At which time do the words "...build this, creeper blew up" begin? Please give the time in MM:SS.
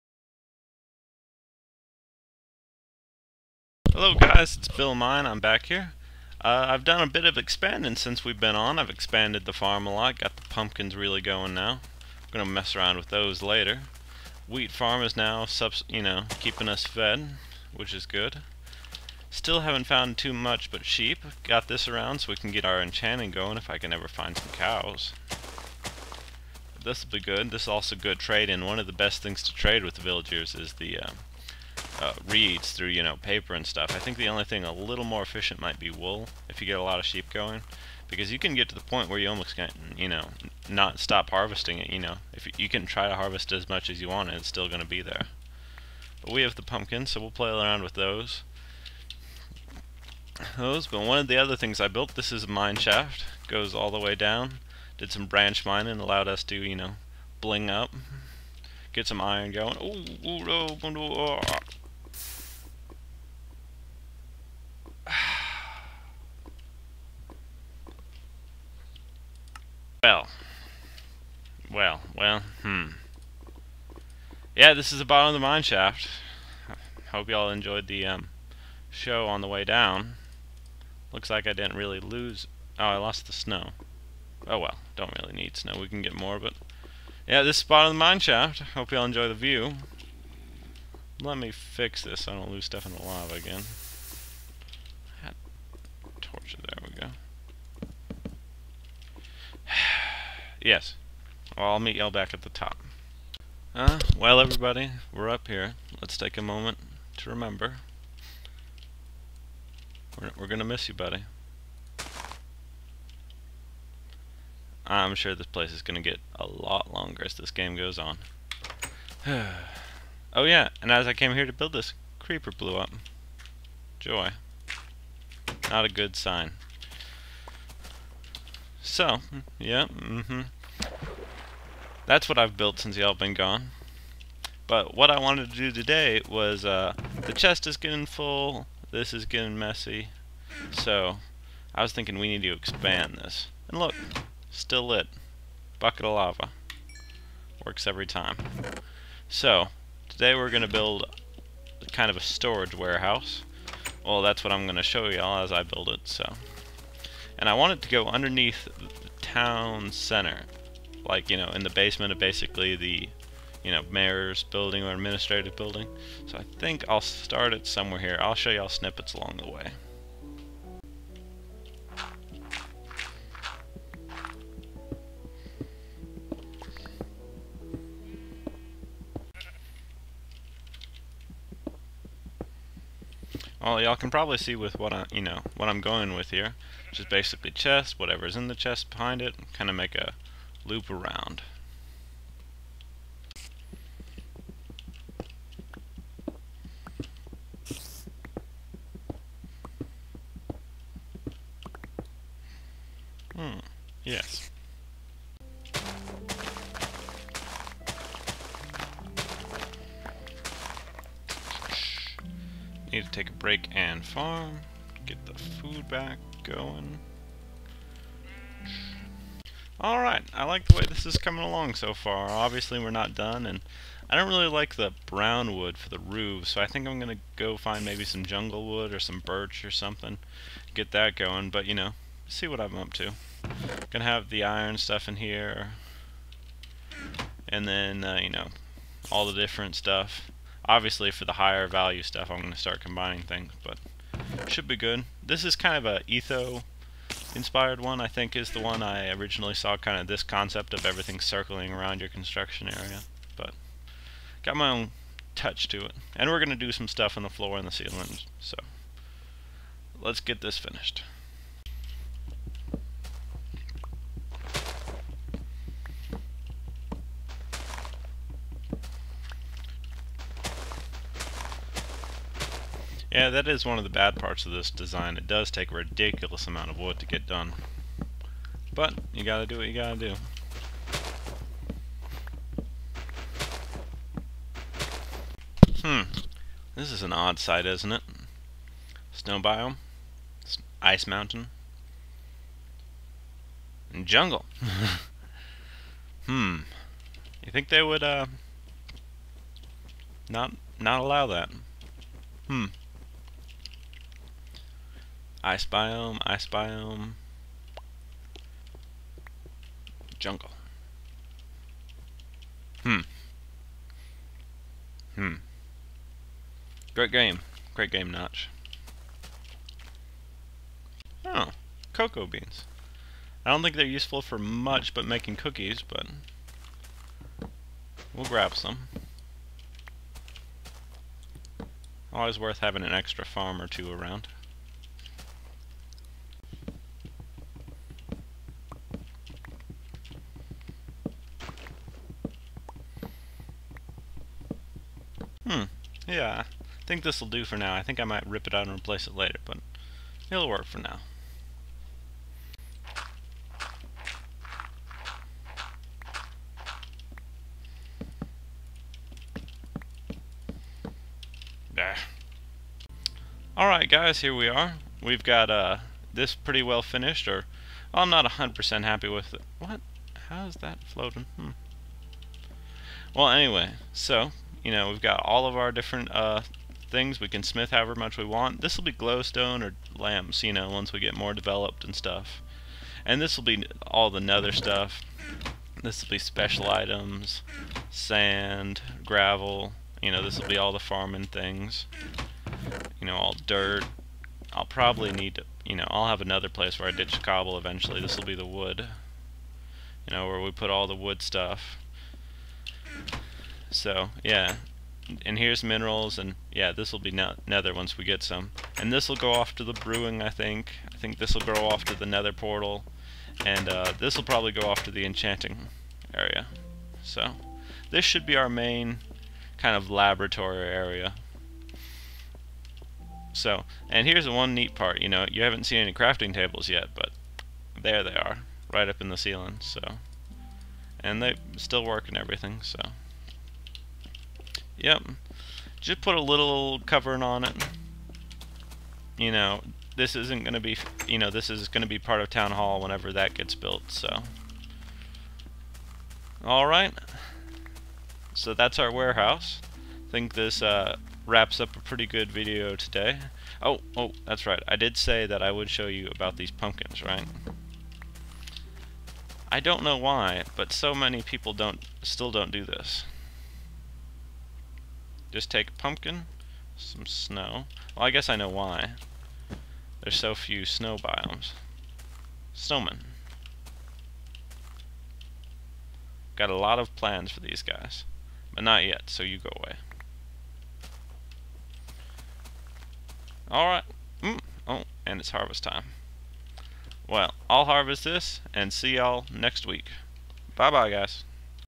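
02:01.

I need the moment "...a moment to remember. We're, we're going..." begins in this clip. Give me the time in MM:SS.
01:46.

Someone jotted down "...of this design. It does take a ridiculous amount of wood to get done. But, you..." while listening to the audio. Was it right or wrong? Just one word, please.
right.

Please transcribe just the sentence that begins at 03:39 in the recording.
Alright, I like the way this is coming along so far.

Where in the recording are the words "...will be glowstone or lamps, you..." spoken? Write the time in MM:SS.
06:18.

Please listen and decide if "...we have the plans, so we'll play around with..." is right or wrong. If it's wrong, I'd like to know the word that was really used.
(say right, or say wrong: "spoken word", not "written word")
wrong: "pumpkins", not "plans".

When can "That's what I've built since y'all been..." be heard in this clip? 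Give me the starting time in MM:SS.
02:12.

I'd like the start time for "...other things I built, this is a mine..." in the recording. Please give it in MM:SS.
00:51.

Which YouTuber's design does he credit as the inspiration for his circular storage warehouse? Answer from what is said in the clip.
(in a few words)
Etho.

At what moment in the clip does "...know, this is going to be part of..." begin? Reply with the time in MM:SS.
07:21.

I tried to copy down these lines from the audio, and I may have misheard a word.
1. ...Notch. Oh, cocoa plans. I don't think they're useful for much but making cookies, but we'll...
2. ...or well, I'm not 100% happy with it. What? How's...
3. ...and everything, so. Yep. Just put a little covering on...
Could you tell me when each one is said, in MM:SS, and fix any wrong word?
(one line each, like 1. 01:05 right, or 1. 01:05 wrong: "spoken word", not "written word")
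1. 05:18 wrong: "beans", not "plans"
2. 06:07 right
3. 07:12 right.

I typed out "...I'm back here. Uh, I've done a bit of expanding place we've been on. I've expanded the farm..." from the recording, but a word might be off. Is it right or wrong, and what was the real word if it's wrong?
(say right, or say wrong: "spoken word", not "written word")
wrong: "since", not "place".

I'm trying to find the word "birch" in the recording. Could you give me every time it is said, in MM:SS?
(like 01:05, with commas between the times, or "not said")
03:49.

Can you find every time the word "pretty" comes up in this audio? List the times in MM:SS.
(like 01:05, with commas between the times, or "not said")
06:06, 07:31.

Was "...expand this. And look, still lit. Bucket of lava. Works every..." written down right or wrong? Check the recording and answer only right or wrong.
right.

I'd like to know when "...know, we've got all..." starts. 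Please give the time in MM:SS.
06:14.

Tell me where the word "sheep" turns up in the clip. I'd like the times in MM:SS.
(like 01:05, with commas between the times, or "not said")
00:20, 00:37.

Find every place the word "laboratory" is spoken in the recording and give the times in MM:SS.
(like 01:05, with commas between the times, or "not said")
06:59.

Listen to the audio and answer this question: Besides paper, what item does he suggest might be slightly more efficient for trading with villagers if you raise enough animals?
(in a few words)
Wool.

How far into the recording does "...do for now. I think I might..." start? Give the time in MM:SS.
05:47.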